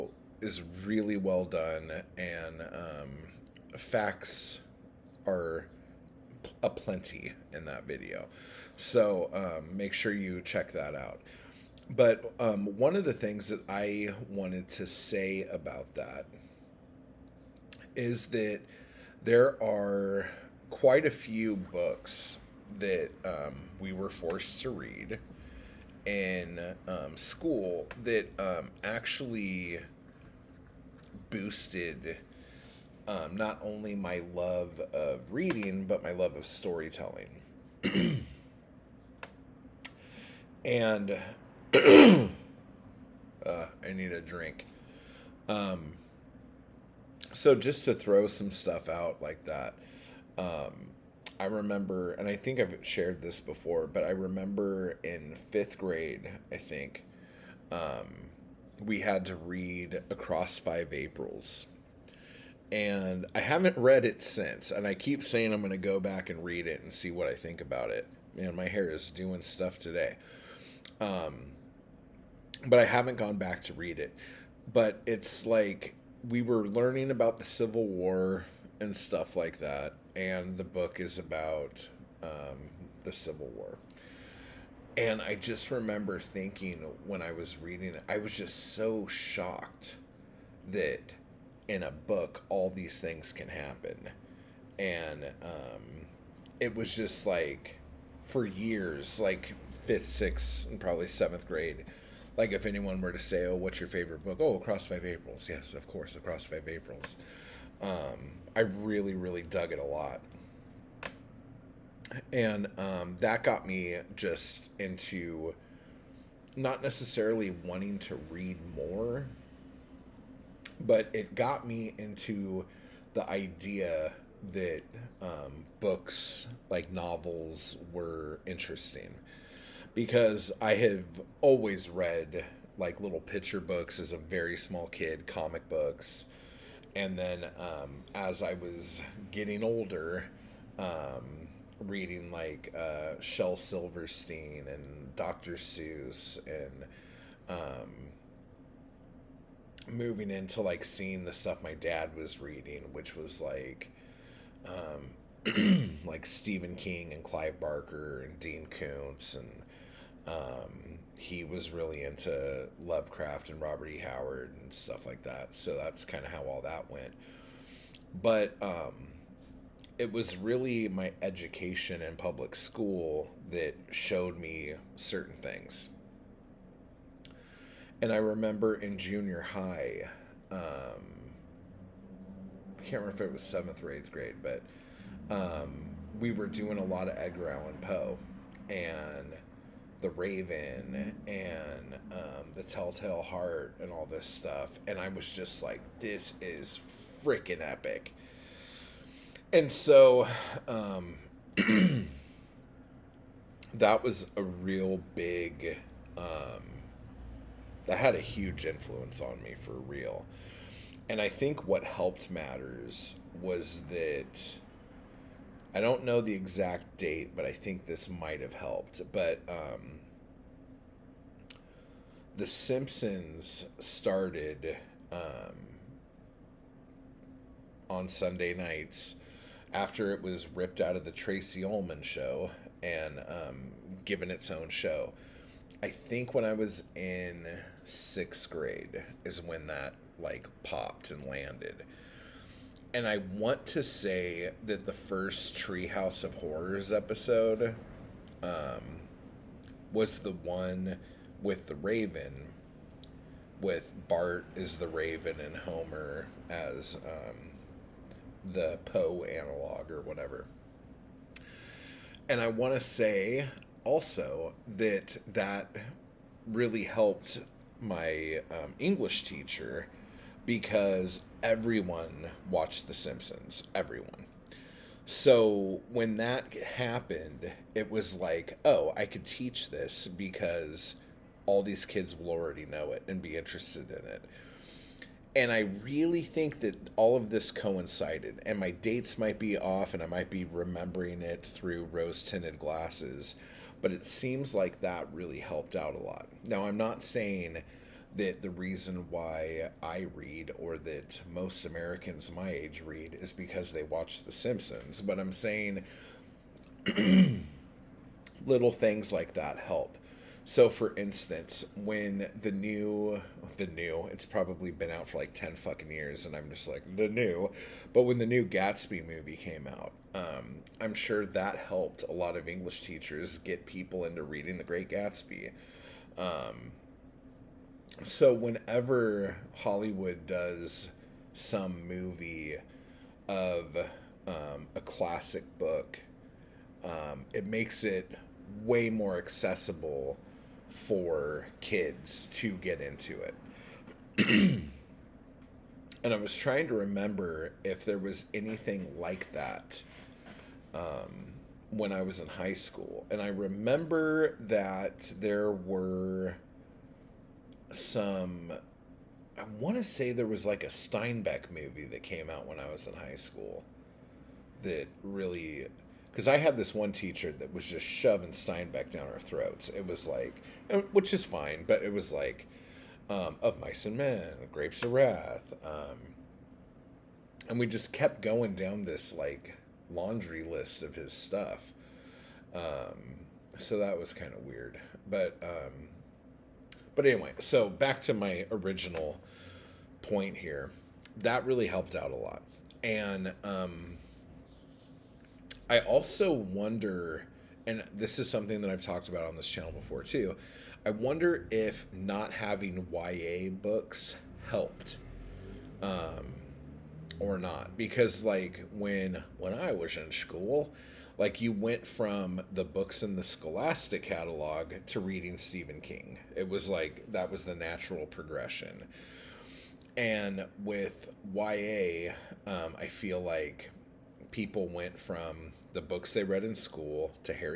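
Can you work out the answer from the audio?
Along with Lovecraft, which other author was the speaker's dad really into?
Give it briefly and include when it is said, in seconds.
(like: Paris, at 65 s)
Robert E. Howard, at 163 s.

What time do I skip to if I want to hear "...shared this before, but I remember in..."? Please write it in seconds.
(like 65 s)
52 s.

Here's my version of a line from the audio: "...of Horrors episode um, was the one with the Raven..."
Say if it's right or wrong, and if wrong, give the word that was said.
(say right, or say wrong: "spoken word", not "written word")
right.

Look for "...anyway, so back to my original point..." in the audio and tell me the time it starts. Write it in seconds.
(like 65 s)
387 s.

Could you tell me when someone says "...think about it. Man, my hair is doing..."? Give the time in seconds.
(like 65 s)
67 s.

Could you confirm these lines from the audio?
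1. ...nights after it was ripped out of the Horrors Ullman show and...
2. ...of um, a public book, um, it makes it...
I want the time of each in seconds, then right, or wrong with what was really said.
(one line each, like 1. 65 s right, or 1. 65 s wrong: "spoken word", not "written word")
1. 228 s wrong: "Tracey", not "Horrors"
2. 333 s wrong: "classic", not "public".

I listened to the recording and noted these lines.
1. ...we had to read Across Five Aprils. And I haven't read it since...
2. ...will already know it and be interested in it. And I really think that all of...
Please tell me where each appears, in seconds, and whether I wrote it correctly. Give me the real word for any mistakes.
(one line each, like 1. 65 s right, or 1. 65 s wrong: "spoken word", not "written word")
1. 58 s right
2. 282 s right.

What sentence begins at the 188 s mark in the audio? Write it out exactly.
And the Raven and um, The Telltale Heart and all this stuff.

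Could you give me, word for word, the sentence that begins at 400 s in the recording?
I wonder if not having YA books helped um, or not.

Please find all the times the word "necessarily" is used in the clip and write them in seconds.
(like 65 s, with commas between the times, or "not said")
116 s.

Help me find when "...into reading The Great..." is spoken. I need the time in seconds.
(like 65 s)
324 s.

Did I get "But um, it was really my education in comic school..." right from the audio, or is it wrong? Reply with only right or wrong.
wrong.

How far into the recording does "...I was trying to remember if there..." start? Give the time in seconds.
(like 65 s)
346 s.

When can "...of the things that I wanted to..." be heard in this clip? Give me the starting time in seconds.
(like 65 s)
12 s.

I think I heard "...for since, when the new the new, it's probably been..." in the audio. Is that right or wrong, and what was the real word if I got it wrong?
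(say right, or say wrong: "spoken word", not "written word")
wrong: "instance", not "since".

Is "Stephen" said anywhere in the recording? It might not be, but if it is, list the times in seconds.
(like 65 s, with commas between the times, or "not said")
156 s, 415 s.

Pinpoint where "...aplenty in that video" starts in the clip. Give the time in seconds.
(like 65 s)
6 s.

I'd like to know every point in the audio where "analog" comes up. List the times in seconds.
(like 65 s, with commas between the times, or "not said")
259 s.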